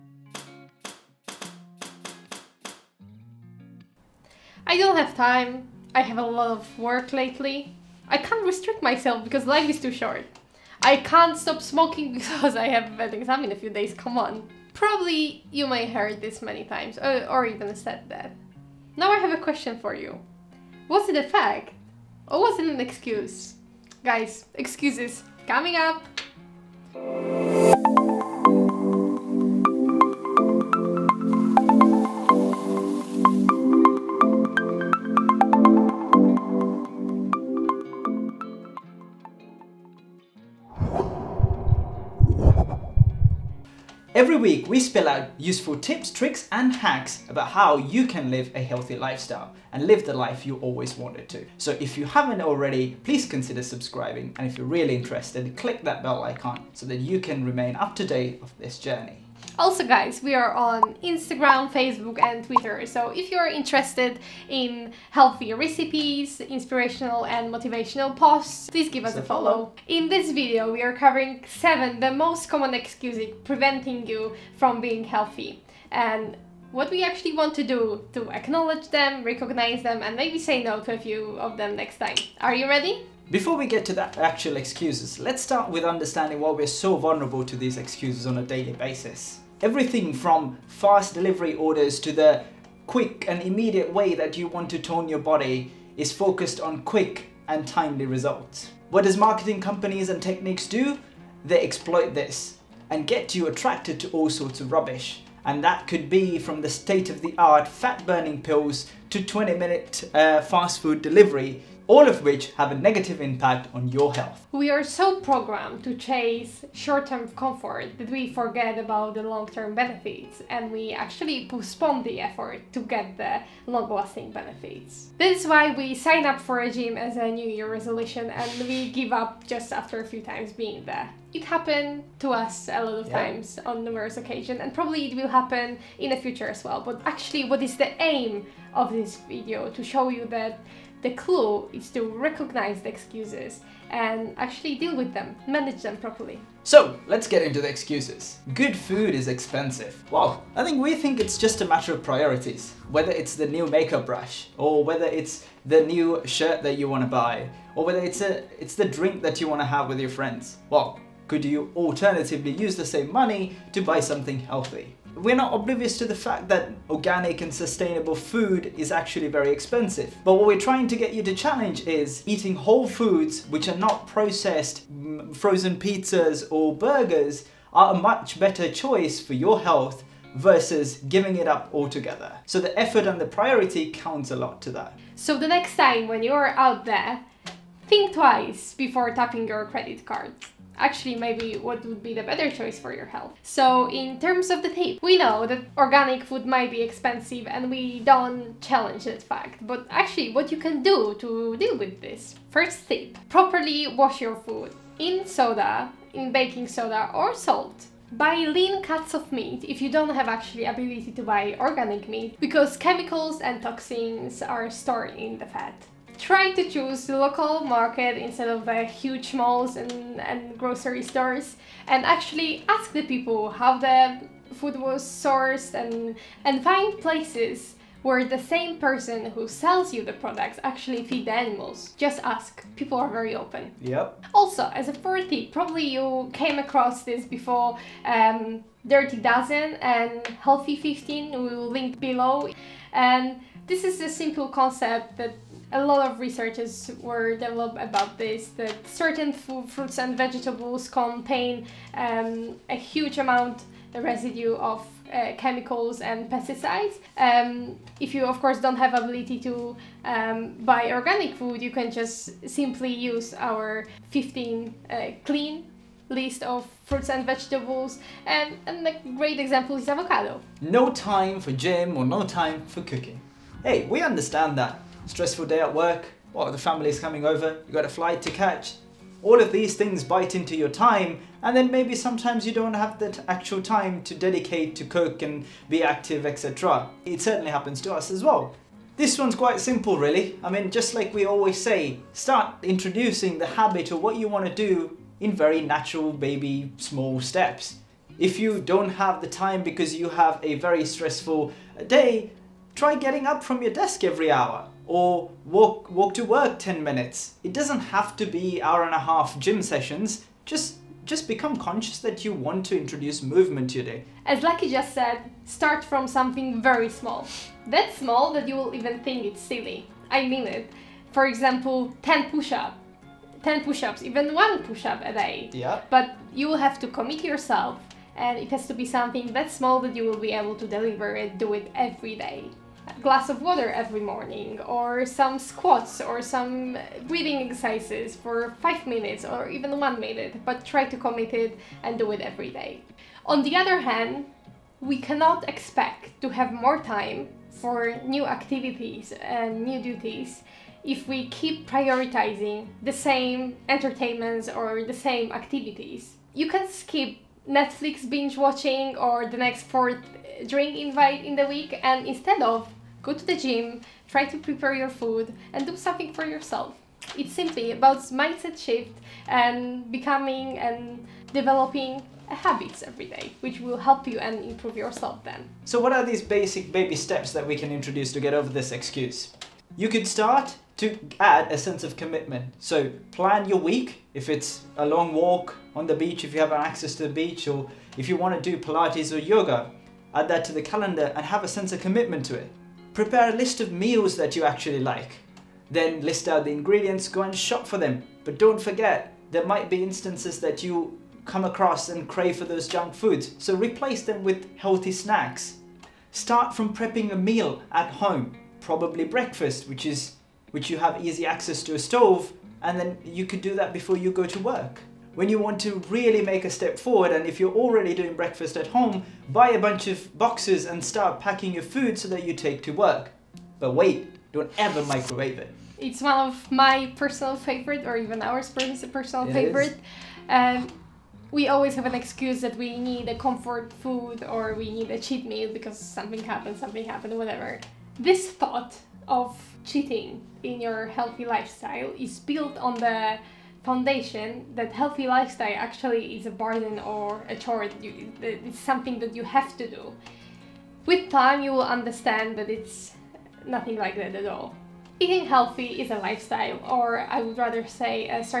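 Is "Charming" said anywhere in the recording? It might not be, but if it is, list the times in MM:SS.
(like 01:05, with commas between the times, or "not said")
not said.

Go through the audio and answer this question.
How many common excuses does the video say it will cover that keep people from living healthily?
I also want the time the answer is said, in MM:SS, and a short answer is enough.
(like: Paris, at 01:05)
7, at 01:11.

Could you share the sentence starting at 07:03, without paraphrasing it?
But wait, don't ever microwave it.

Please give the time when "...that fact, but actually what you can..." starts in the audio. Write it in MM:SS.
03:19.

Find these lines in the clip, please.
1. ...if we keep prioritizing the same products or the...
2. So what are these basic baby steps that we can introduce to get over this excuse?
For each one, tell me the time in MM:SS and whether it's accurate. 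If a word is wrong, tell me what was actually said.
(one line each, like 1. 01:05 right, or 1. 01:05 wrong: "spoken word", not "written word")
1. 05:50 wrong: "entertainments", not "products"
2. 06:15 right.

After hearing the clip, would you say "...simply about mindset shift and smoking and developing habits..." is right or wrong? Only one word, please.
wrong.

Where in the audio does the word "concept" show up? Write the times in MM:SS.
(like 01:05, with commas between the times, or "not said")
04:04.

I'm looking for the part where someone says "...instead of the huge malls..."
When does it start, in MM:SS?
03:38.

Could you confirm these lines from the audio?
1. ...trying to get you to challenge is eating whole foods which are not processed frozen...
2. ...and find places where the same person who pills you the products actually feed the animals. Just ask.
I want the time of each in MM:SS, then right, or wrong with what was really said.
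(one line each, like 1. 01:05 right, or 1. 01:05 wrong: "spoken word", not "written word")
1. 02:50 right
2. 03:46 wrong: "sells", not "pills".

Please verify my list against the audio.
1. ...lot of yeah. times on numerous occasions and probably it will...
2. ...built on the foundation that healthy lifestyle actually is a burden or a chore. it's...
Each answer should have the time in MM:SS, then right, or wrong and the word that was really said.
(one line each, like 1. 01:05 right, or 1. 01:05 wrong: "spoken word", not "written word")
1. 02:12 right
2. 07:22 right.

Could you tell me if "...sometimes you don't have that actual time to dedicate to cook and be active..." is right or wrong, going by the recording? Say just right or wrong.
right.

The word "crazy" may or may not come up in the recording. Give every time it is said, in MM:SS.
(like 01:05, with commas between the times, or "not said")
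not said.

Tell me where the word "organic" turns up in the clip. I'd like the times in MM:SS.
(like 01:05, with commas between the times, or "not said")
02:46, 03:15, 03:31, 04:20.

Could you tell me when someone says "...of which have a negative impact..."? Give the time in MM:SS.
01:52.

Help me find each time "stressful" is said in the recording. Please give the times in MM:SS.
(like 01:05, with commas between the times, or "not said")
04:35, 05:00.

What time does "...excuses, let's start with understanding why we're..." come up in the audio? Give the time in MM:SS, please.
01:24.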